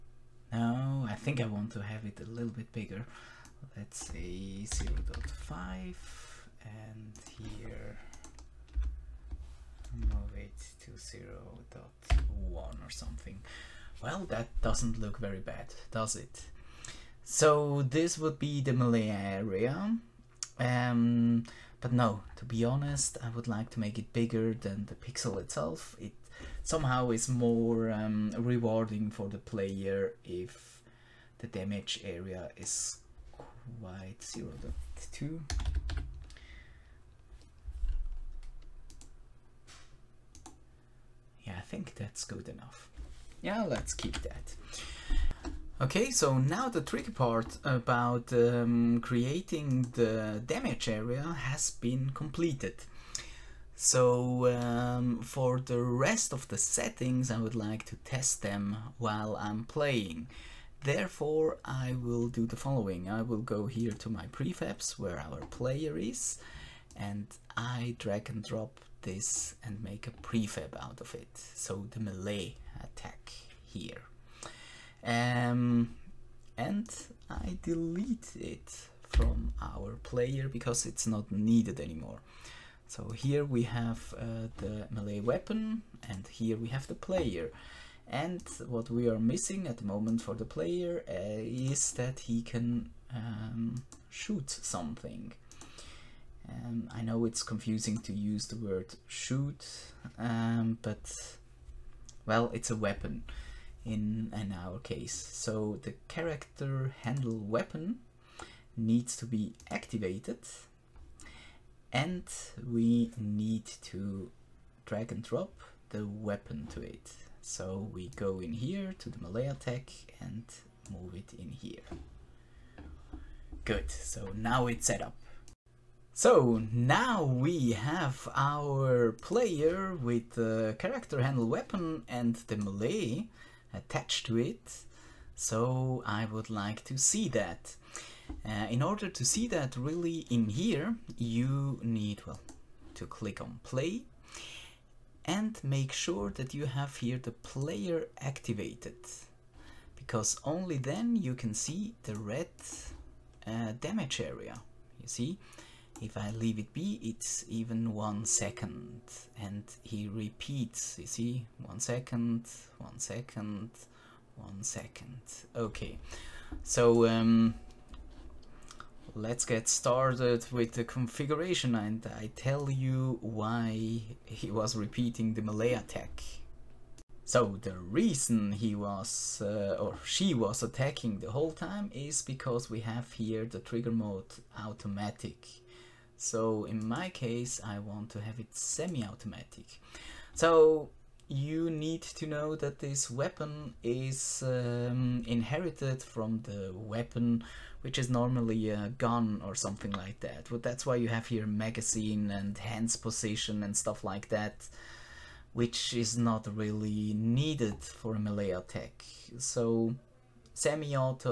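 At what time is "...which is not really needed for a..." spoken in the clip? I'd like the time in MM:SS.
03:25.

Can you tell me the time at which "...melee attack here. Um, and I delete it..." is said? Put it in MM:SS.
01:12.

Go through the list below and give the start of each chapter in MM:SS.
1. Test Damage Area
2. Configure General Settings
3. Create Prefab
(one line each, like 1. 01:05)
1. 02:05
2. 02:56
3. 00:45.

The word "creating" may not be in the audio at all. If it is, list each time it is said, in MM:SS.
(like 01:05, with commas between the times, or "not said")
00:49.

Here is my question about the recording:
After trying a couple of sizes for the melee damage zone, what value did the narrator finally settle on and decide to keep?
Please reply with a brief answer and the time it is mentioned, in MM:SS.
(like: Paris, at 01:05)
0 0.2, at 00:34.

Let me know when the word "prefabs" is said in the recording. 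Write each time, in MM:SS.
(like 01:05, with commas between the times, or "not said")
01:04, 01:10.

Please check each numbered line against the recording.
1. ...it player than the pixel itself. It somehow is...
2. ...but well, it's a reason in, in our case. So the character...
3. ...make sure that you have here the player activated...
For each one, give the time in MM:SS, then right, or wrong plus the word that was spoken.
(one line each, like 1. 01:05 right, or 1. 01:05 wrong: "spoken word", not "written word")
1. 00:23 wrong: "bigger", not "player"
2. 01:40 wrong: "weapon", not "reason"
3. 02:25 right.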